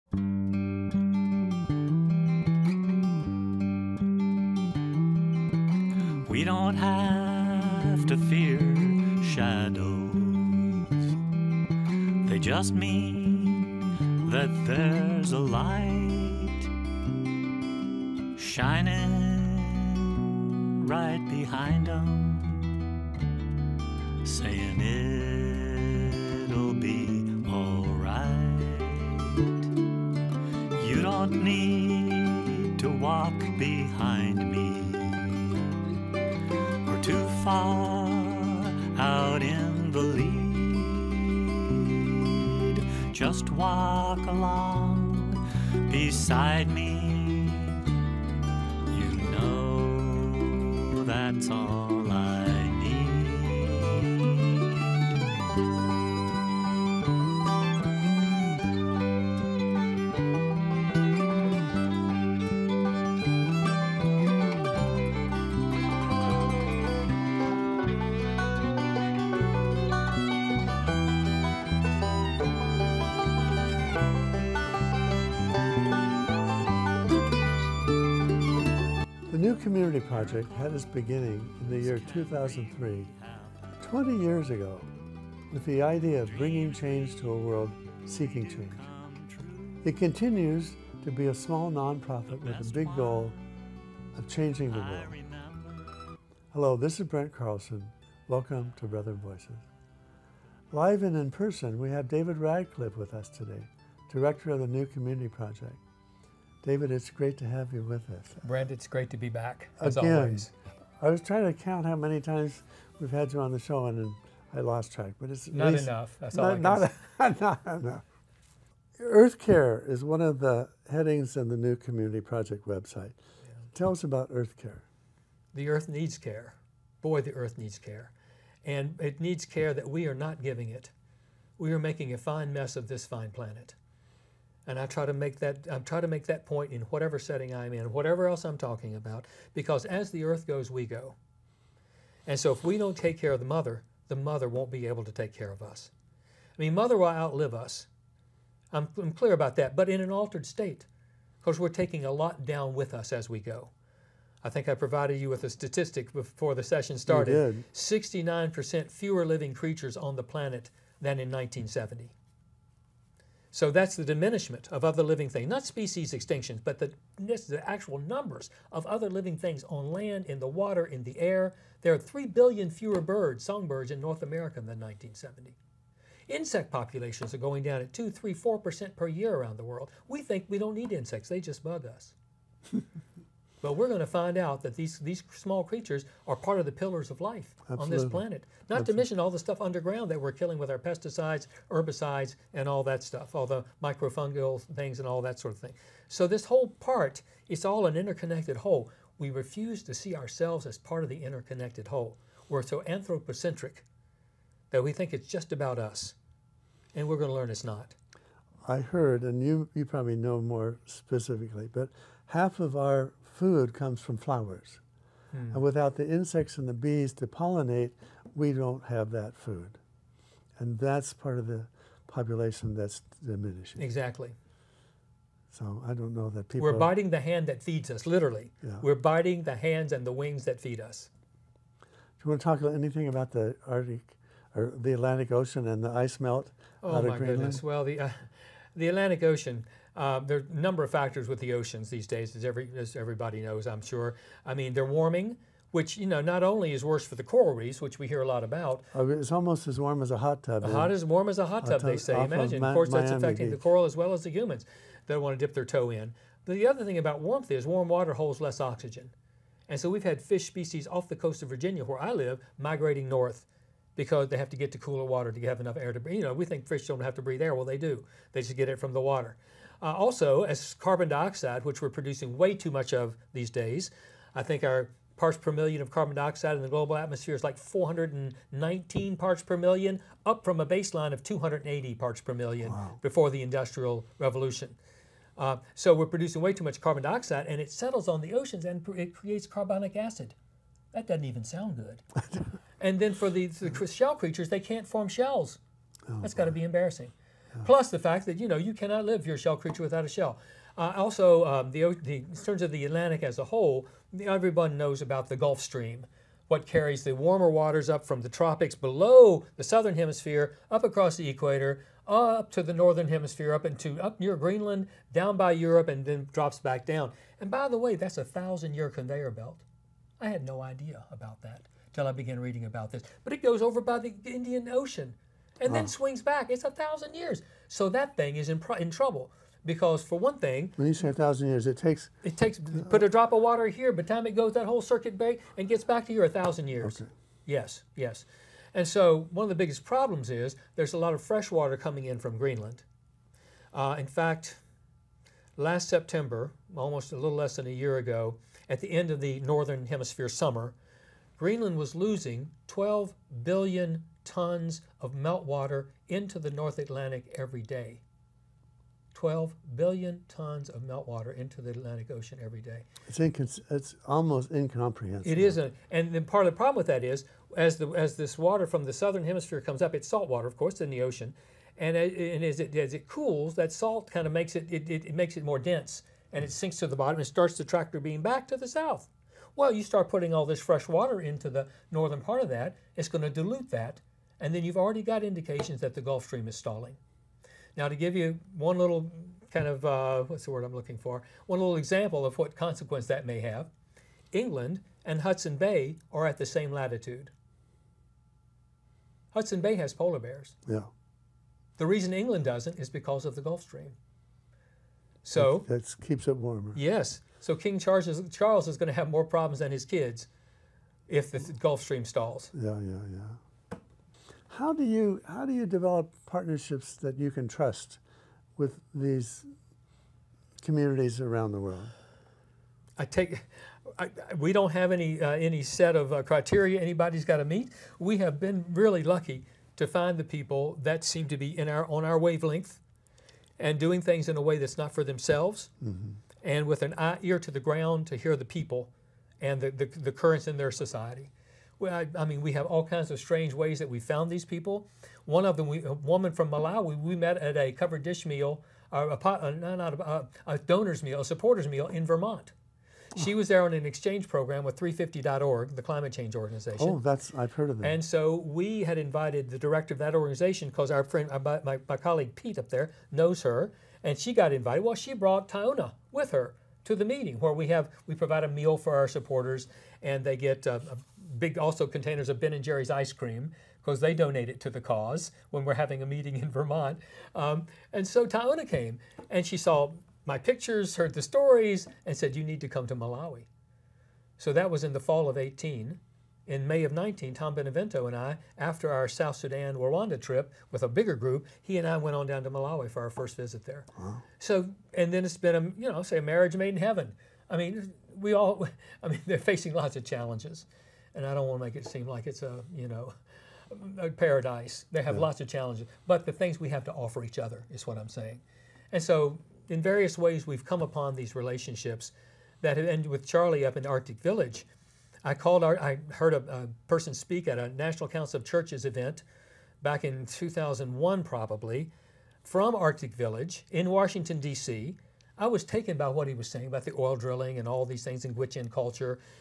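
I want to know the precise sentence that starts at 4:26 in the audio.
You know, we think fish don't have to breathe air.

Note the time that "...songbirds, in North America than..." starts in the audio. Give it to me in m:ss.
2:53.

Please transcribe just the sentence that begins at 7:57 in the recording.
Um, and so Taona came and she saw my pictures, heard the stories, and said, You need to come to Malawi.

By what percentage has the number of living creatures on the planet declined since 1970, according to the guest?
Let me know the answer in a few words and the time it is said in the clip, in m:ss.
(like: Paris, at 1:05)
69%, at 2:37.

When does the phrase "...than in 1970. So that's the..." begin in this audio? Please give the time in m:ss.
2:41.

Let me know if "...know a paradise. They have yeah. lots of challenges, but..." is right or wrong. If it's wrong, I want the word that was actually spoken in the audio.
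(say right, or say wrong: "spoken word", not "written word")
right.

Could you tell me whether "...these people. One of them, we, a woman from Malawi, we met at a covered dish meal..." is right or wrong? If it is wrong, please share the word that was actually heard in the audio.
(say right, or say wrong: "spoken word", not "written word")
right.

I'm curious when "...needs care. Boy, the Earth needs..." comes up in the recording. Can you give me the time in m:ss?
2:05.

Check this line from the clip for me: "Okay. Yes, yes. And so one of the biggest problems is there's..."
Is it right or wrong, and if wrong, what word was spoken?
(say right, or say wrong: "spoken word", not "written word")
right.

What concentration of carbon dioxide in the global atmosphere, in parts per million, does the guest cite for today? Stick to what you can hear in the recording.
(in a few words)
419.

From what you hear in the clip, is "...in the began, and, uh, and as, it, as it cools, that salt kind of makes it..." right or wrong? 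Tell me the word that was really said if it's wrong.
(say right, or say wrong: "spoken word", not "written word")
wrong: "ocean", not "began".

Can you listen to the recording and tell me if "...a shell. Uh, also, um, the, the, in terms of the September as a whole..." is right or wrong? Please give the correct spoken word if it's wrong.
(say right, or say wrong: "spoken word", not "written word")
wrong: "Atlantic", not "September".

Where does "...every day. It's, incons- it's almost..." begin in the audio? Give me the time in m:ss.
6:02.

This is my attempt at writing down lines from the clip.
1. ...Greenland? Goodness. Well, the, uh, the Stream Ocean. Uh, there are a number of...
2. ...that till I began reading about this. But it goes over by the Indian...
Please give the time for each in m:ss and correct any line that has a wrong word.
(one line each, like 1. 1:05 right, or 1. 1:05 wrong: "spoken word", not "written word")
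1. 3:57 wrong: "Atlantic", not "Stream"
2. 5:21 right.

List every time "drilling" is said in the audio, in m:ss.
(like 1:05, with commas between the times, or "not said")
8:47.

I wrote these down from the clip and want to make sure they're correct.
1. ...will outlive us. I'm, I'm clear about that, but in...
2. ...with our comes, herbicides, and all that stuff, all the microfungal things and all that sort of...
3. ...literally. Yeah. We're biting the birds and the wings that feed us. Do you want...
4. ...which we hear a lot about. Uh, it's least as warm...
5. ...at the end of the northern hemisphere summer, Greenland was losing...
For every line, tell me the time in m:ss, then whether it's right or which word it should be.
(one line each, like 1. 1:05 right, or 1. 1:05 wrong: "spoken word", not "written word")
1. 2:26 right
2. 3:10 wrong: "pesticides", not "comes"
3. 3:48 wrong: "hands", not "birds"
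4. 4:07 wrong: "almost", not "least"
5. 5:48 right.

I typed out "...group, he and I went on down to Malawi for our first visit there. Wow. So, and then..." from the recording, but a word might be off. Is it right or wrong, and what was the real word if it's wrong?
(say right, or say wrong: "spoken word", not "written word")
right.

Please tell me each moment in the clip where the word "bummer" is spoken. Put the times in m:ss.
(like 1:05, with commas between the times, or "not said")
not said.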